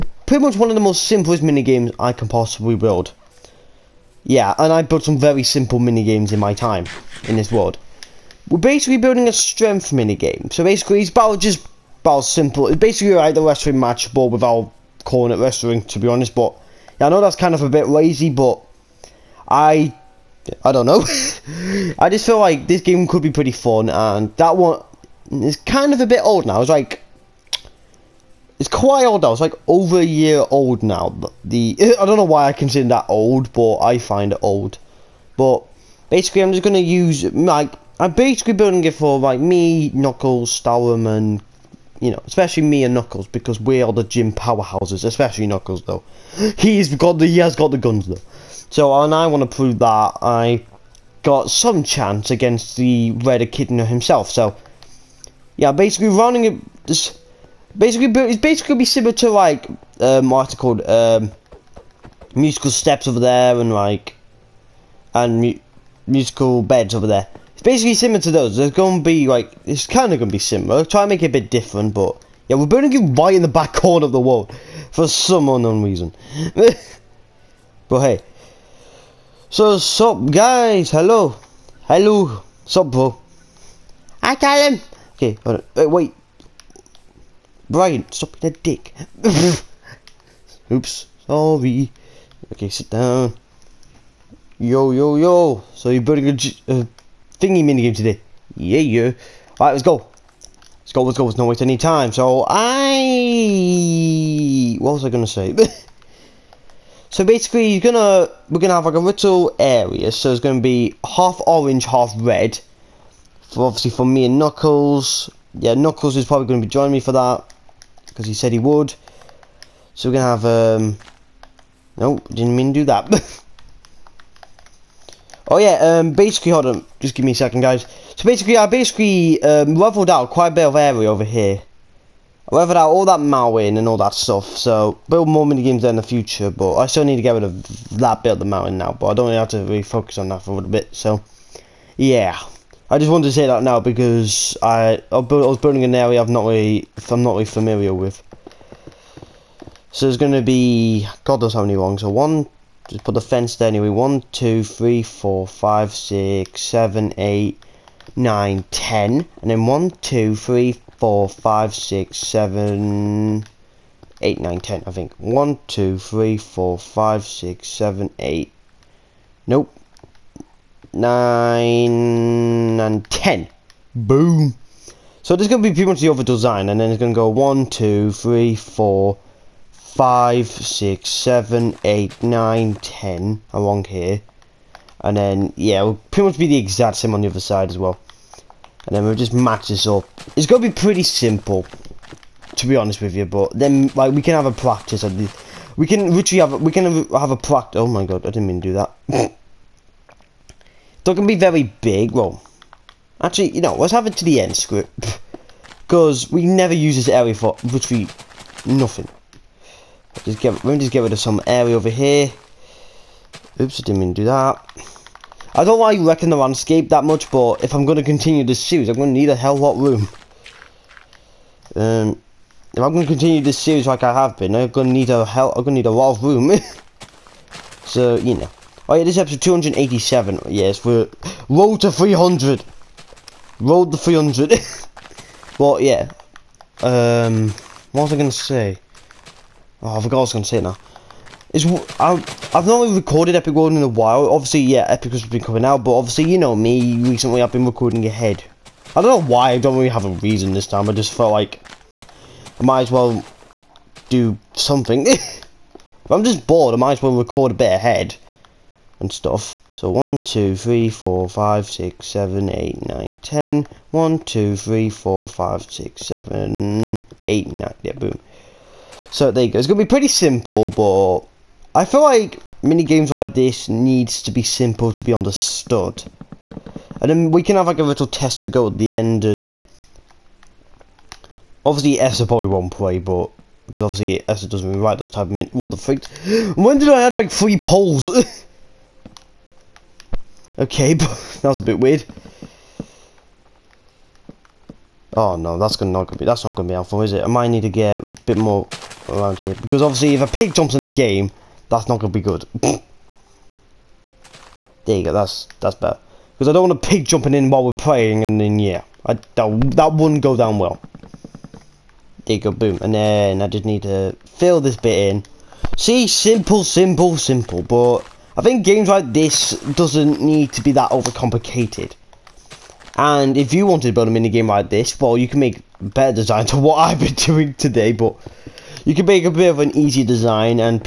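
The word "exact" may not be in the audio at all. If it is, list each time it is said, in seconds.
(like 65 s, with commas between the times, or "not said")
186 s.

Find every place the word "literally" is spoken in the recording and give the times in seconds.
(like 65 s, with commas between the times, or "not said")
196 s, 207 s.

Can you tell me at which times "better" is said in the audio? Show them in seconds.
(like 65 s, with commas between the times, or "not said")
305 s, 325 s.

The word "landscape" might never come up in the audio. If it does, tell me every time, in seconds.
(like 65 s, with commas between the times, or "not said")
216 s.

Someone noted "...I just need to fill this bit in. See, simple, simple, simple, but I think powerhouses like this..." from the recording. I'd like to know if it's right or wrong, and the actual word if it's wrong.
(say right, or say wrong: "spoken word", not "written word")
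wrong: "games", not "powerhouses".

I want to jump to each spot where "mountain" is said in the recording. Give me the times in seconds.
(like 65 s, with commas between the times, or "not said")
133 s, 138 s.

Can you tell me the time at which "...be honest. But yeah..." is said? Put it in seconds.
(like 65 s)
15 s.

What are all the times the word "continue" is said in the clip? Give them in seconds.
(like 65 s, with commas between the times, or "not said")
218 s, 223 s.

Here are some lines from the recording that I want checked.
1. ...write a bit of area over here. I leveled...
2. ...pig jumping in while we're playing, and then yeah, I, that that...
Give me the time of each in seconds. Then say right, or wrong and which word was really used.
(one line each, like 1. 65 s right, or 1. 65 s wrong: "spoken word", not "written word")
1. 130 s wrong: "quite", not "write"
2. 306 s right.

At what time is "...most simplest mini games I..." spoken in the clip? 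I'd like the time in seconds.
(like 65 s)
0 s.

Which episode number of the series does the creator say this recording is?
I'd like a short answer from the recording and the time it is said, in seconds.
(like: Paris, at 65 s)
287, at 229 s.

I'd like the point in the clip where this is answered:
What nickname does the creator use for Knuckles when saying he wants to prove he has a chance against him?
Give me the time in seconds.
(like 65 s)
53 s.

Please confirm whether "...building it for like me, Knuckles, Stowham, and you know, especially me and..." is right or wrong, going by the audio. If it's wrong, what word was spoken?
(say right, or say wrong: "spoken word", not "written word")
right.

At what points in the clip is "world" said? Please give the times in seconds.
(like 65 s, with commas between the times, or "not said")
7 s, 74 s, 243 s.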